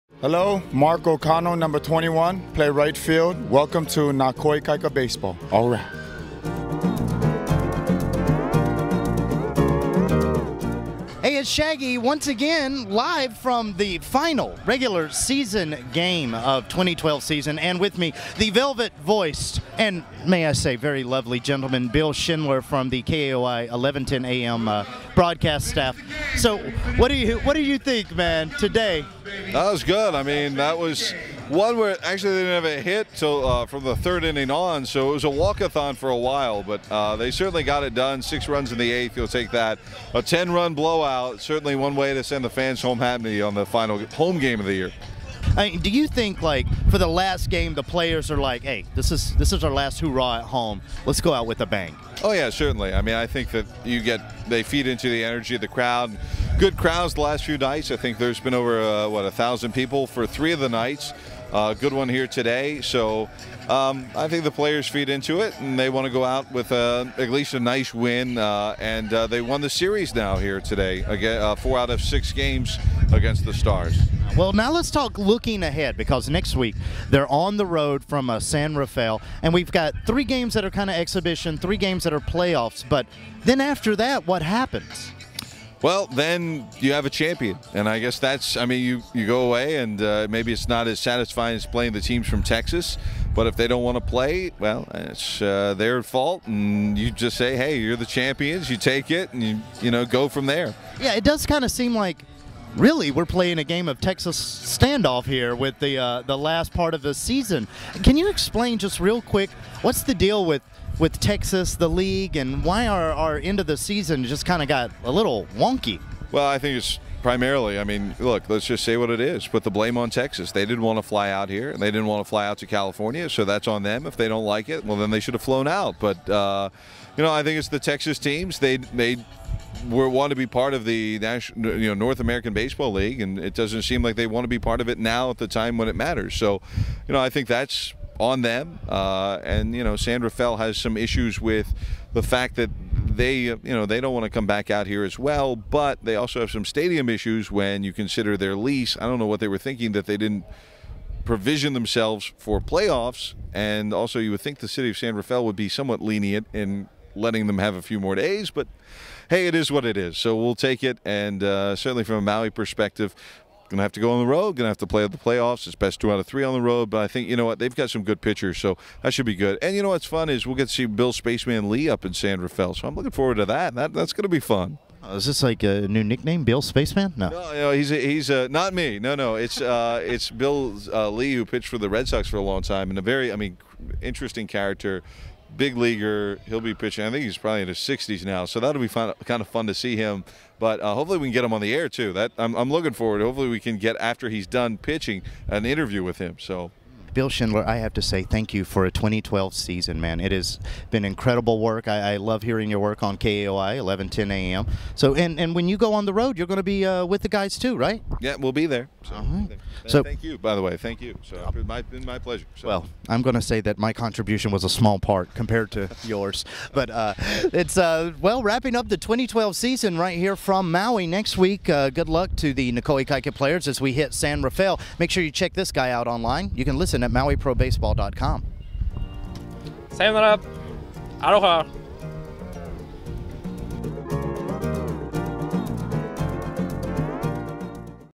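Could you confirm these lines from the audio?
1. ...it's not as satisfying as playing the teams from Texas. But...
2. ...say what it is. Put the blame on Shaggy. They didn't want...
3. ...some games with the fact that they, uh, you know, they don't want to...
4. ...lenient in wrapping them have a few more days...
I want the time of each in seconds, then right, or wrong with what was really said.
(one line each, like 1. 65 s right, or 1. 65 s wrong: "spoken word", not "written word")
1. 90 s right
2. 118 s wrong: "Texas", not "Shaggy"
3. 140 s wrong: "issues", not "games"
4. 156 s wrong: "letting", not "wrapping".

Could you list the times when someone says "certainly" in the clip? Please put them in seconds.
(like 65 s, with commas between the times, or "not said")
37 s, 41 s, 52 s, 161 s.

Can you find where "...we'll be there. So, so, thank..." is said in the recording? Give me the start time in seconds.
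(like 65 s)
208 s.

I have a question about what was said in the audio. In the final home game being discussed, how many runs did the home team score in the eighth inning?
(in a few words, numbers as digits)
6.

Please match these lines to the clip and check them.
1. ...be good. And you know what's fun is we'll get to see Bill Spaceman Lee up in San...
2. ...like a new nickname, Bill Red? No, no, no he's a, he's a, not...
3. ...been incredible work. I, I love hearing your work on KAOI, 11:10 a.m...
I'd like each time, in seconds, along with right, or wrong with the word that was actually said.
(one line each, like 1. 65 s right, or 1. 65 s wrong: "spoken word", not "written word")
1. 169 s right
2. 175 s wrong: "Spaceman", not "Red"
3. 200 s right.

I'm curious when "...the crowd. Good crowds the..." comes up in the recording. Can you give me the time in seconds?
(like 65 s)
55 s.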